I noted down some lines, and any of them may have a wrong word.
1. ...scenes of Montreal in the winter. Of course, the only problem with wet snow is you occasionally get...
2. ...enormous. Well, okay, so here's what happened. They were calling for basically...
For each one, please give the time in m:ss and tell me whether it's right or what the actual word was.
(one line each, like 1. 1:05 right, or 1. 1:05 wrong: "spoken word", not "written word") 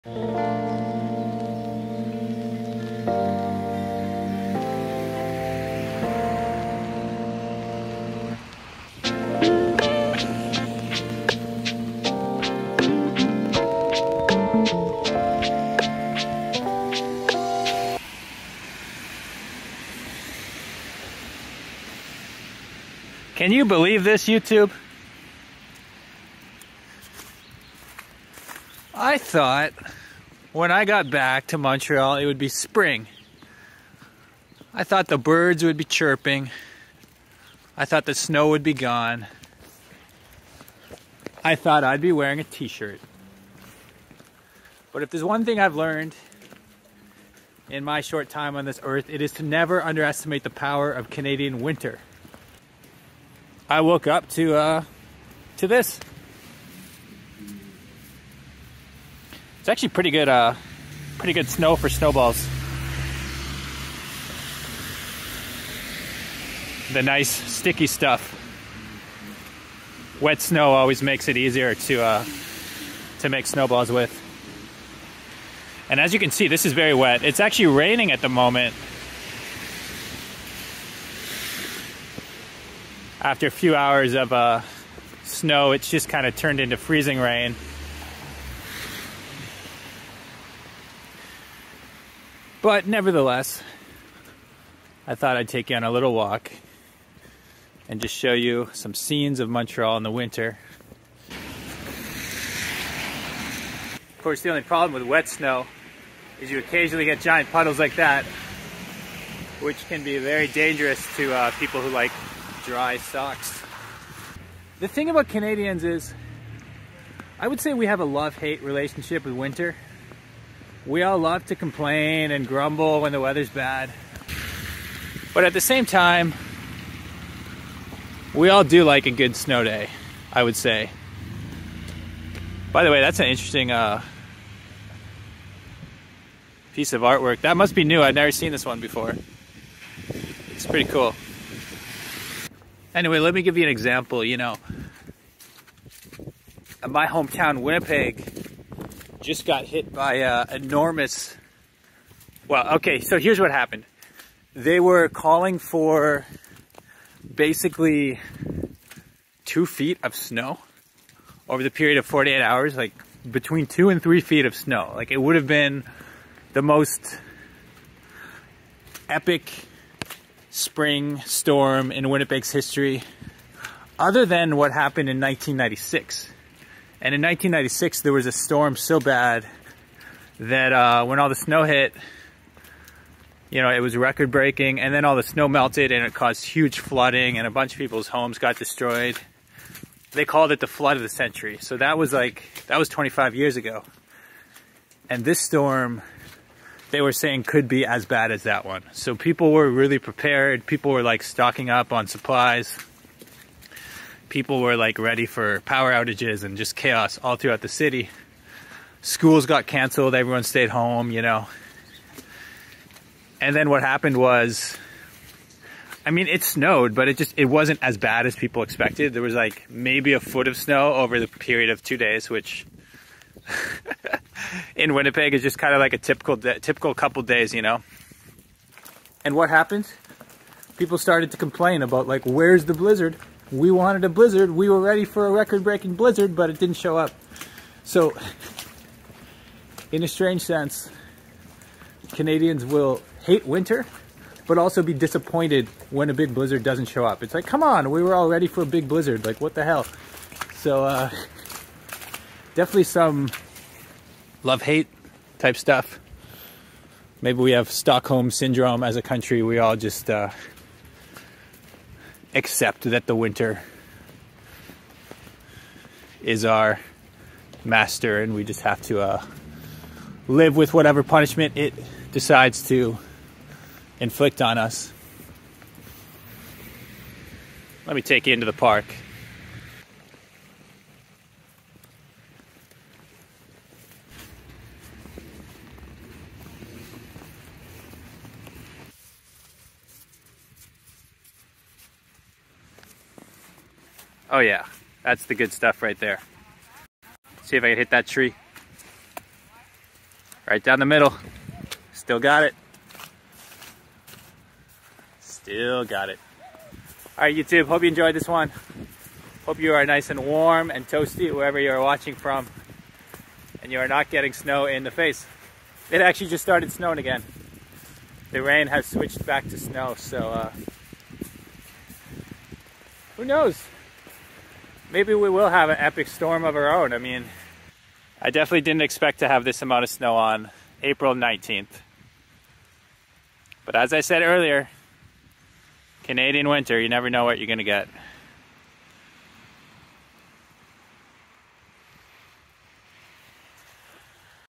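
1. 1:38 right
2. 2:30 right.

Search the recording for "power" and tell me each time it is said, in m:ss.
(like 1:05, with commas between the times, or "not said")
0:50, 3:25.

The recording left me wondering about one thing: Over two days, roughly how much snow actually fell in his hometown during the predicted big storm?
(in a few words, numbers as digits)
A foot.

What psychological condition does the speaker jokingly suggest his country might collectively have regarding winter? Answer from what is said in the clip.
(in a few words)
Stockholm syndrome.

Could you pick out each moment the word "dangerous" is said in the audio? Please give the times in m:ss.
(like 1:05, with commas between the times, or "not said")
1:50.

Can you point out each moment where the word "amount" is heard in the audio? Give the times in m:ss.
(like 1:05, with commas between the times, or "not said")
5:29.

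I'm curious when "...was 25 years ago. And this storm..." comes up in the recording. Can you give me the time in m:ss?
3:12.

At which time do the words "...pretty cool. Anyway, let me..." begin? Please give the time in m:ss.
2:20.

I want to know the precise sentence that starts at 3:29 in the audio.
Schools got canceled, everyone stayed home, you know.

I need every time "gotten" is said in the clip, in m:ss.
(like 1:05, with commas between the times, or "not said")
not said.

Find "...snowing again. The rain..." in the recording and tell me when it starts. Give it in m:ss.
5:16.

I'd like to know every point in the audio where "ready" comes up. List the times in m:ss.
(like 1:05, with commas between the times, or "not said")
3:24, 3:54, 4:08.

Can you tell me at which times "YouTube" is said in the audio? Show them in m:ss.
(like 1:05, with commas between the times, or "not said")
0:24, 5:07.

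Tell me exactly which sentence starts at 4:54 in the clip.
Oh yeah, that's the good stuff right there.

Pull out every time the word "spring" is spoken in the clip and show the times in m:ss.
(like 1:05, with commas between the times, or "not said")
0:32, 2:50.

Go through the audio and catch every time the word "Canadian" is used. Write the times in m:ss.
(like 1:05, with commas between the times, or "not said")
0:51, 1:55, 4:02, 5:36.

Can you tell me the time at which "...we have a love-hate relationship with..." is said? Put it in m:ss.
1:57.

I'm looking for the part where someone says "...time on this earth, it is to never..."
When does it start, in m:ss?
0:48.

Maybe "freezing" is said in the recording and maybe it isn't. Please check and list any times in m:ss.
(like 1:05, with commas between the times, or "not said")
1:26.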